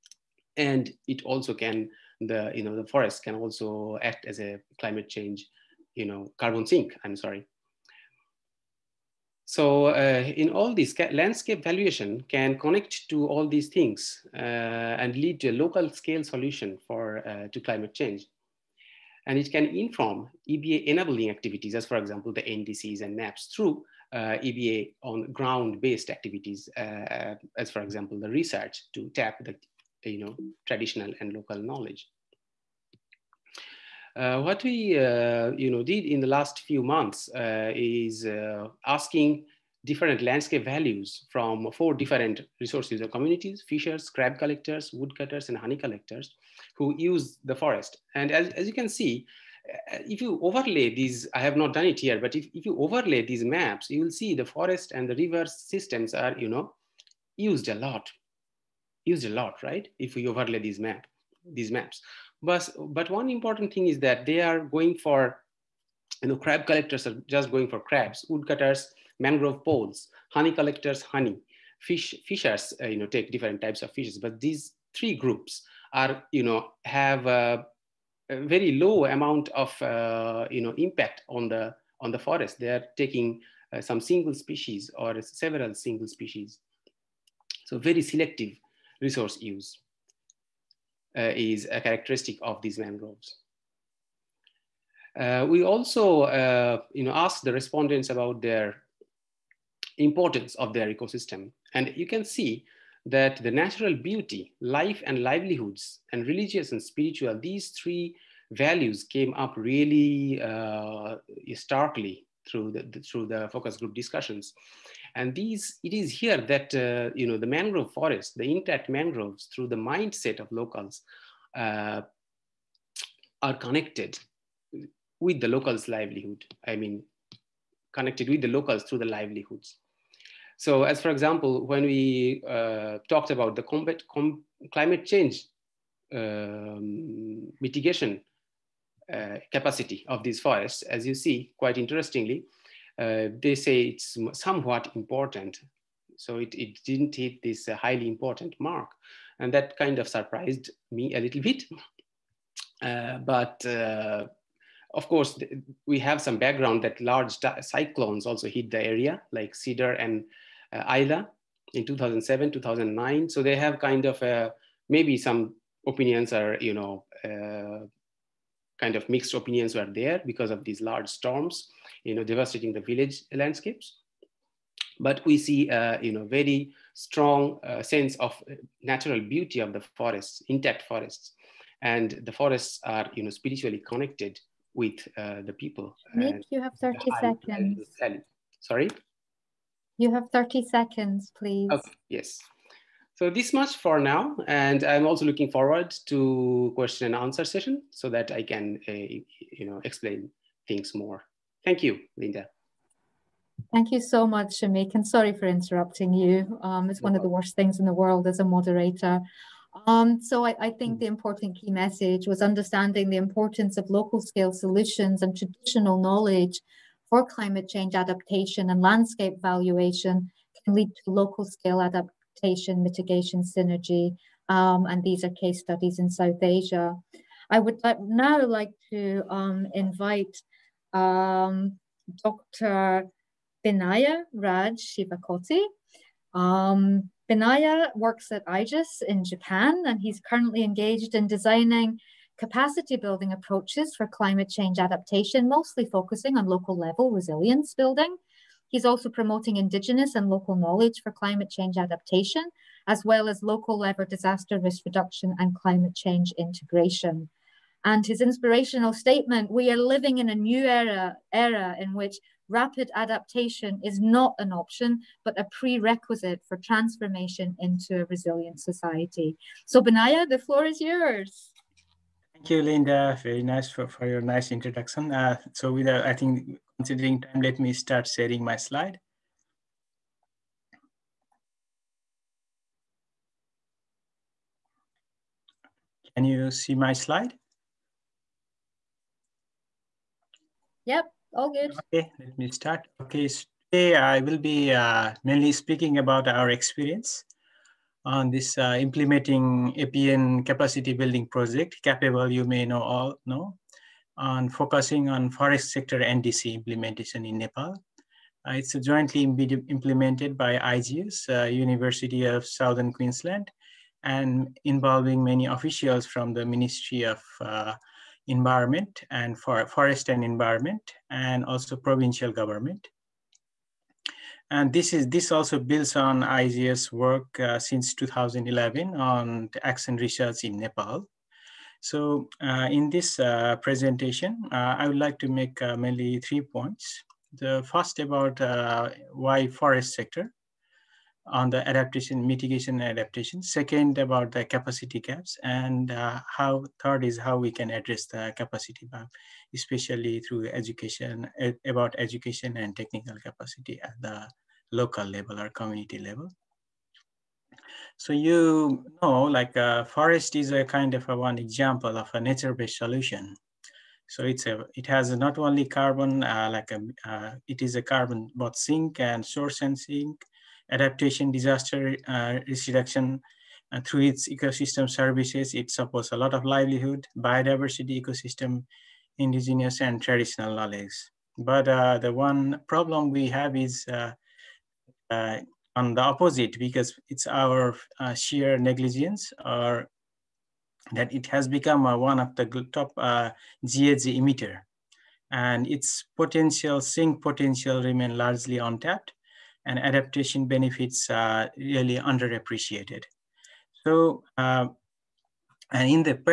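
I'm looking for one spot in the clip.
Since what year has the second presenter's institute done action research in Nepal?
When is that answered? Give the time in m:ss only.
5:27.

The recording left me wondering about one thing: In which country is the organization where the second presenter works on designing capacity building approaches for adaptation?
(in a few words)
Japan.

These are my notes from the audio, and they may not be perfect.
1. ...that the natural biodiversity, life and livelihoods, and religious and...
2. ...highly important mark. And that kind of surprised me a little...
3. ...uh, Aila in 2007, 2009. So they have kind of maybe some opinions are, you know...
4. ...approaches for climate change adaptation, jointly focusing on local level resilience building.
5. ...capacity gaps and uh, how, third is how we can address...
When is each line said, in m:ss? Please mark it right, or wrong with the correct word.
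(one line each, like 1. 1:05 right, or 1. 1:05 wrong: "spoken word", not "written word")
1. 1:43 wrong: "beauty", not "biodiversity"
2. 2:27 right
3. 2:40 right
4. 4:03 wrong: "mostly", not "jointly"
5. 5:44 right.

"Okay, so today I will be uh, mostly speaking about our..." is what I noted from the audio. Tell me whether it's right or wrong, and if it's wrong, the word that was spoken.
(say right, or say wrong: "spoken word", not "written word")
wrong: "mainly", not "mostly".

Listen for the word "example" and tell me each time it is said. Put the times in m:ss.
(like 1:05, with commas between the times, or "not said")
0:21, 0:27, 2:11, 6:01.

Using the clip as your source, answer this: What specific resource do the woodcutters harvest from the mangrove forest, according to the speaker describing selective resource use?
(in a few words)
Mangrove poles.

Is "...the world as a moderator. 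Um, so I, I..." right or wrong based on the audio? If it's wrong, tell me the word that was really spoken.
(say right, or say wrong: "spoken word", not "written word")
right.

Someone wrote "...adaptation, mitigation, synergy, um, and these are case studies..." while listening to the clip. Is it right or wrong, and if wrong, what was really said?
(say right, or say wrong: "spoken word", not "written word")
right.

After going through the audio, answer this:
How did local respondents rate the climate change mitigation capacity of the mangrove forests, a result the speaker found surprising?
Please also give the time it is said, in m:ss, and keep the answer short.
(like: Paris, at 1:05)
Somewhat important, at 2:24.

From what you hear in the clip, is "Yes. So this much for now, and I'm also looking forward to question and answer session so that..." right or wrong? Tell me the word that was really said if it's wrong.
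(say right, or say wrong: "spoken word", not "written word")
right.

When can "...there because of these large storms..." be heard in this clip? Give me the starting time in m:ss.
2:49.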